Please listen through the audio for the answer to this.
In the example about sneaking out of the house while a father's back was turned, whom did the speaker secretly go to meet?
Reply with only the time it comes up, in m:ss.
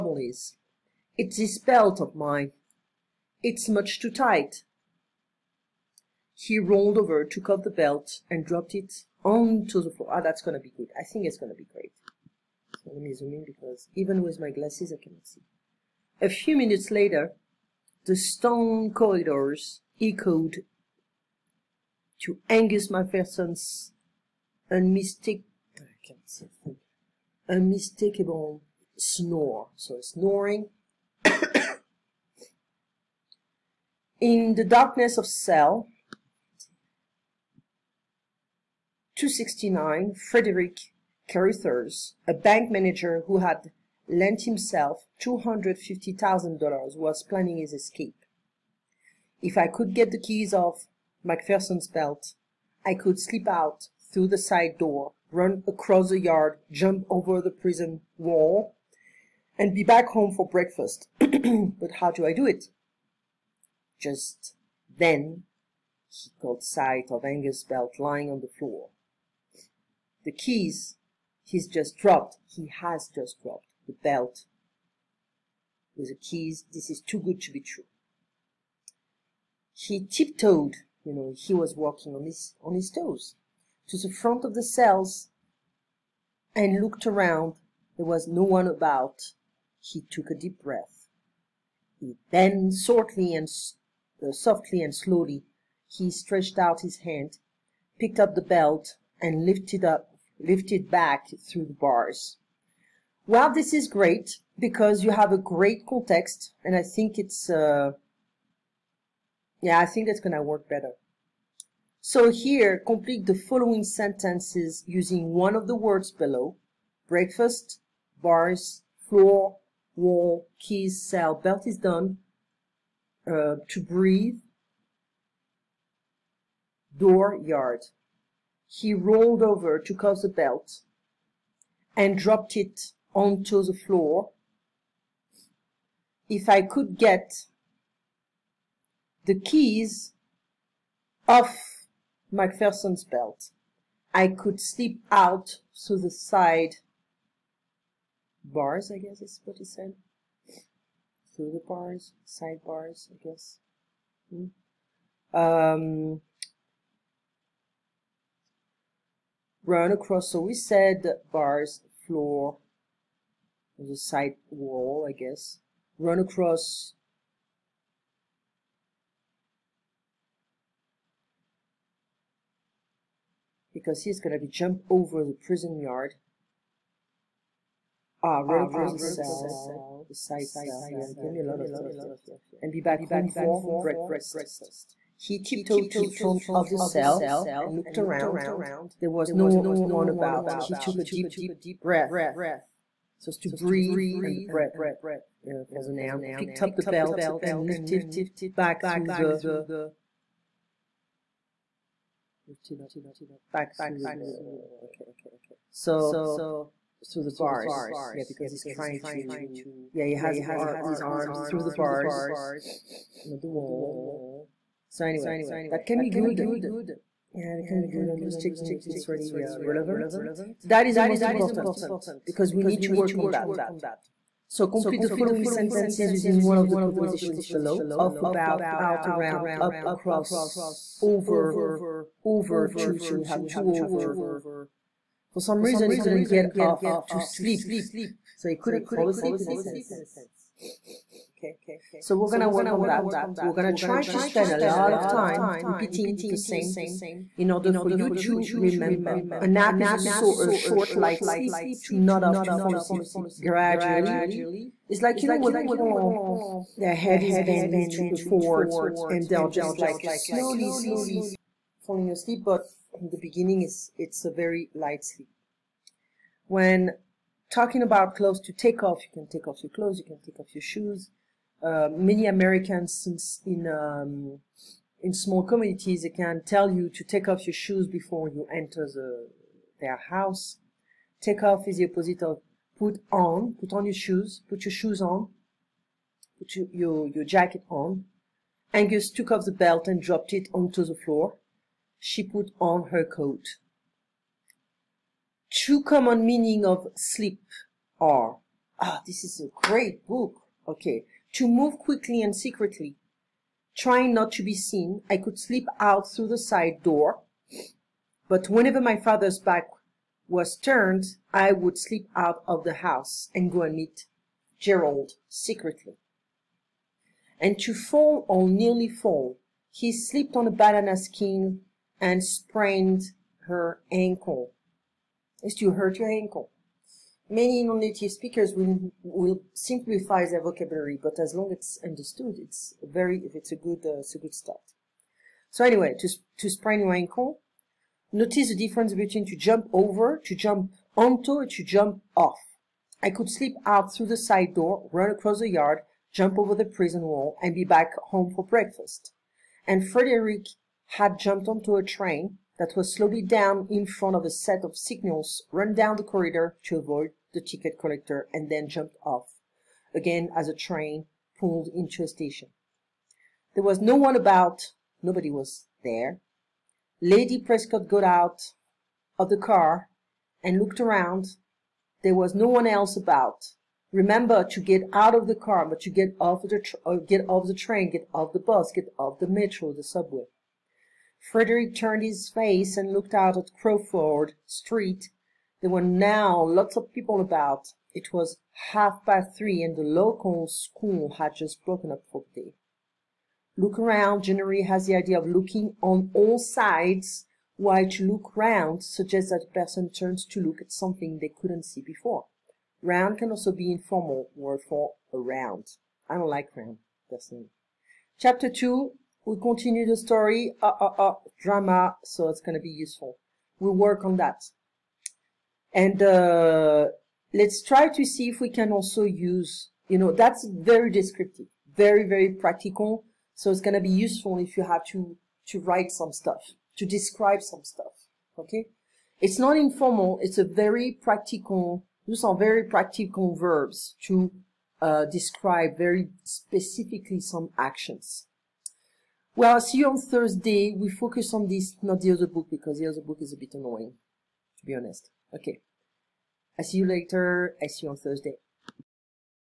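5:14.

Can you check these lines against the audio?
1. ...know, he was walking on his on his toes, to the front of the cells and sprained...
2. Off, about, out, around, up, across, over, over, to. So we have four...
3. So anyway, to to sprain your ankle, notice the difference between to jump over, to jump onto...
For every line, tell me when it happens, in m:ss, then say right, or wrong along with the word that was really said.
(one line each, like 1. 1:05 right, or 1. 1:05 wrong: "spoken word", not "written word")
1. 1:21 wrong: "looked", not "sprained"
2. 3:47 wrong: "two", not "four"
3. 5:35 right.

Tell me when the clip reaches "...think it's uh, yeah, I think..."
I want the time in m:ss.
1:46.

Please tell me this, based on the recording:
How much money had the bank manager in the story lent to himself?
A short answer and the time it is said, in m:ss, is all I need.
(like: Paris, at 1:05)
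$250,000, at 0:45.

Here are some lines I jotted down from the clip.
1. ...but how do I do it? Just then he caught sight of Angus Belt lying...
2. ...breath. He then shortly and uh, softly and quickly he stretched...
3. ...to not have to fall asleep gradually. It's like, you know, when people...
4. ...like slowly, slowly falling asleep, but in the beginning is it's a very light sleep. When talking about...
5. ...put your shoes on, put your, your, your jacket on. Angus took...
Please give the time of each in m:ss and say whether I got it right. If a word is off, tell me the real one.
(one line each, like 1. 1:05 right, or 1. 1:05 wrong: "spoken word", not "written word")
1. 1:01 right
2. 1:30 wrong: "slowly", not "quickly"
3. 4:11 right
4. 4:19 right
5. 4:44 right.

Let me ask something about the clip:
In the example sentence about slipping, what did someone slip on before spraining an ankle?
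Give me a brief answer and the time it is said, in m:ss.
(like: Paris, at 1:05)
a banana skin, at 5:20.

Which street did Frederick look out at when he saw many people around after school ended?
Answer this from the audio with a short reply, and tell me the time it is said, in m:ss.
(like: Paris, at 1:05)
Crawford Street, at 6:23.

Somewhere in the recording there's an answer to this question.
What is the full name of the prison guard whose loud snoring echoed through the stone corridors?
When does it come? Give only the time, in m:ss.
0:22.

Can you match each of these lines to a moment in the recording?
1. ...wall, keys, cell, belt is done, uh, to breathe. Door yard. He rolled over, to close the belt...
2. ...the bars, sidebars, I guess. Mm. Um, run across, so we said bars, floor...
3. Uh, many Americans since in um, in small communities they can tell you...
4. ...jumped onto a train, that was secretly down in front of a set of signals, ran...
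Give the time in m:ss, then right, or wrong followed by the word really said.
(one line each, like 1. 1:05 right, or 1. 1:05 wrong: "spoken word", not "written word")
1. 1:59 right
2. 2:31 right
3. 4:31 right
4. 5:51 wrong: "slowly", not "secretly".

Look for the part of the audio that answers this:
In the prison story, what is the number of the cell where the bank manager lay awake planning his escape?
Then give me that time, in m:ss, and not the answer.
0:35.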